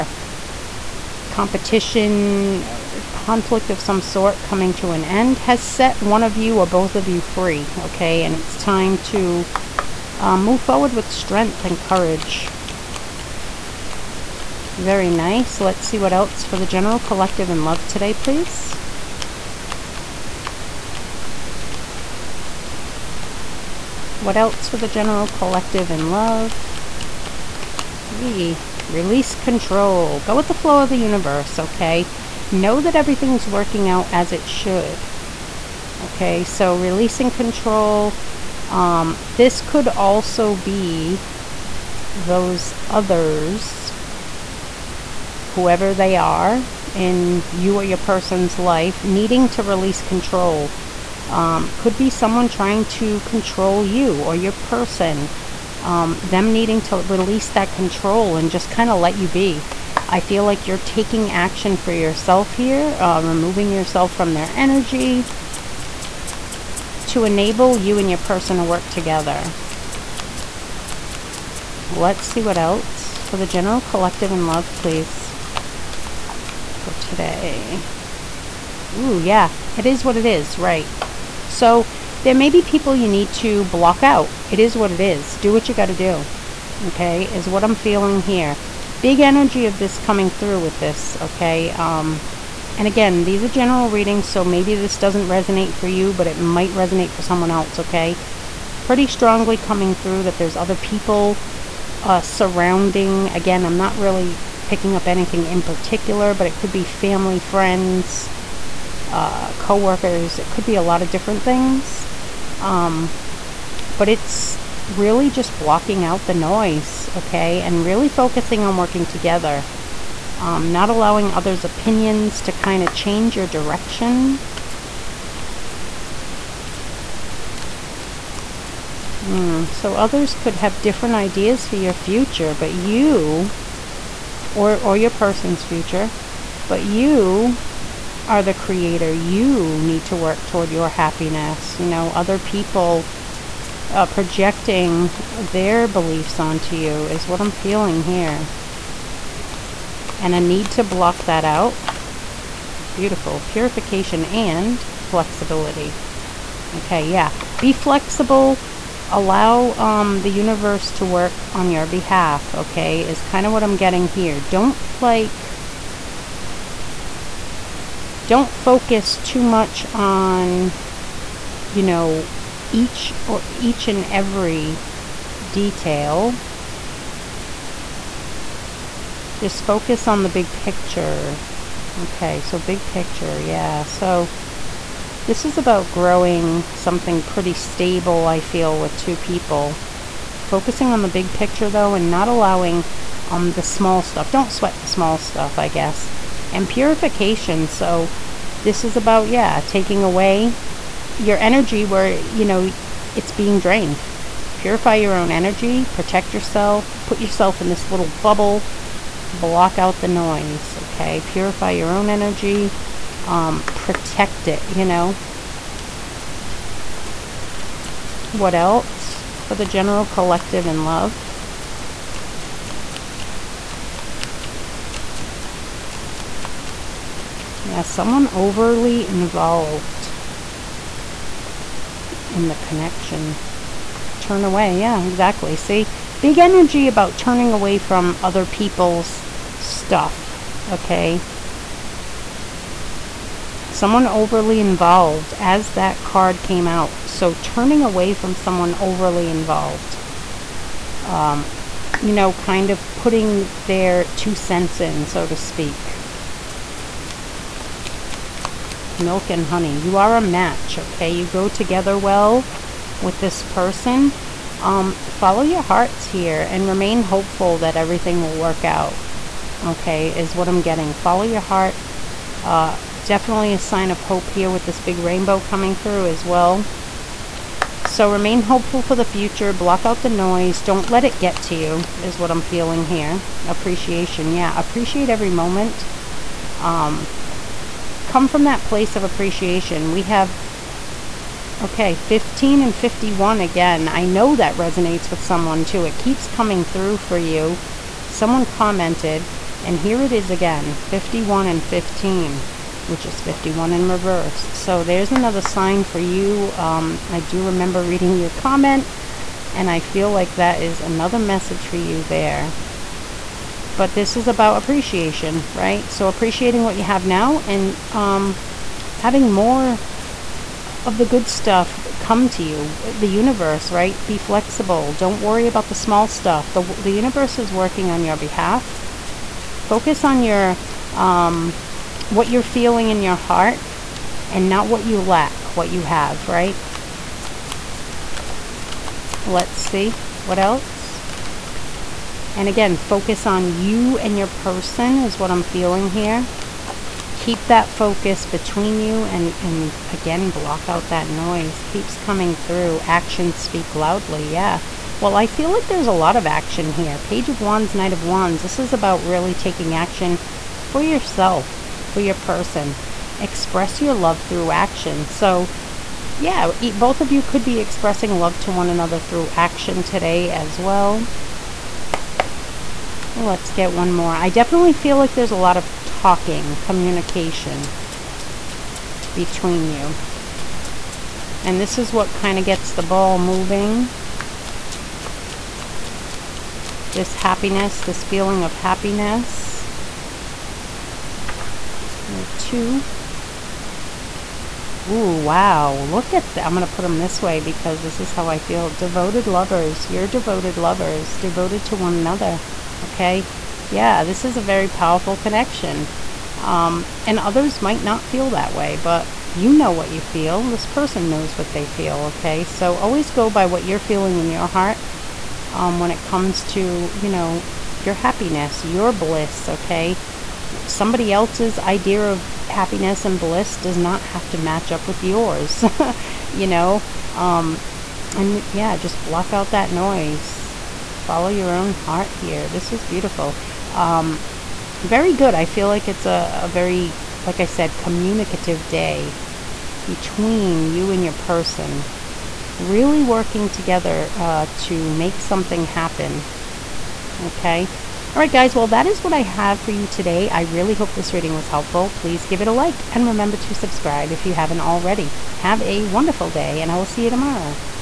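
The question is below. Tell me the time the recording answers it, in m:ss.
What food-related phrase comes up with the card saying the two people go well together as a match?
4:19.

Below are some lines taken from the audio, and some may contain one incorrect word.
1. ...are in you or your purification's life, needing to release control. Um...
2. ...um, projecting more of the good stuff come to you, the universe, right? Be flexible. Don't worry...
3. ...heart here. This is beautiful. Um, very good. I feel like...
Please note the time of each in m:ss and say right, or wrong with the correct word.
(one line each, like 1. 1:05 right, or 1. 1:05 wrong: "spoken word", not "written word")
1. 0:46 wrong: "person", not "purification"
2. 5:17 wrong: "having", not "projecting"
3. 7:11 right.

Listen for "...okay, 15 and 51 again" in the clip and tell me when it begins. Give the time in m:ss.
4:51.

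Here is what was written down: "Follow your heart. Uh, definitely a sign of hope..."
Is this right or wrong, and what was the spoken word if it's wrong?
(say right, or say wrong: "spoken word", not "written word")
right.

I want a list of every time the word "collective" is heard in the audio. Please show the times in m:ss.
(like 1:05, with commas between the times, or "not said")
0:16, 0:25, 1:13, 3:40.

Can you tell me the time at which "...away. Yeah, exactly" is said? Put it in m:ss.
3:54.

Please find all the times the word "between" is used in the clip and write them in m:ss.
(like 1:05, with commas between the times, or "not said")
5:48, 6:19, 7:19.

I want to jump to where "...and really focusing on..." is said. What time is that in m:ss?
1:57.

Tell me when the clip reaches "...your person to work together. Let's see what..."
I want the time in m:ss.
1:08.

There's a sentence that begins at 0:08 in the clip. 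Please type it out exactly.
And it's time to um, move forward with strength and courage.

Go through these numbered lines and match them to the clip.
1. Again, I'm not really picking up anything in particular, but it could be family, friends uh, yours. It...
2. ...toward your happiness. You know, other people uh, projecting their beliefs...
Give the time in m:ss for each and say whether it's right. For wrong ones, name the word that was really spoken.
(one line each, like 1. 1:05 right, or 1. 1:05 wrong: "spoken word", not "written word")
1. 1:43 wrong: "coworkers", not "yours"
2. 2:20 right.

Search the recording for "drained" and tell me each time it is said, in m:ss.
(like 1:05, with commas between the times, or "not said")
3:23.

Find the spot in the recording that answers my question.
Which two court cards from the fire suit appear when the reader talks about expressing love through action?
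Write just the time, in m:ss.
5:56.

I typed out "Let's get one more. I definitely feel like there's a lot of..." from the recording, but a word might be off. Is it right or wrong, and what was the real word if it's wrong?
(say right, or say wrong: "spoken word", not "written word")
right.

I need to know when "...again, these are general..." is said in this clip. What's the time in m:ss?
1:32.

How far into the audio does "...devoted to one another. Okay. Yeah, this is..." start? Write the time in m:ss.
6:41.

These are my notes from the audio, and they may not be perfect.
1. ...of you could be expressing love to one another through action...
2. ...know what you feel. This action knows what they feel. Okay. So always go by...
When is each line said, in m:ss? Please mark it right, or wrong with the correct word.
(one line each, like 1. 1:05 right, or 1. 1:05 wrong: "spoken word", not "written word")
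1. 6:07 right
2. 6:49 wrong: "person", not "action".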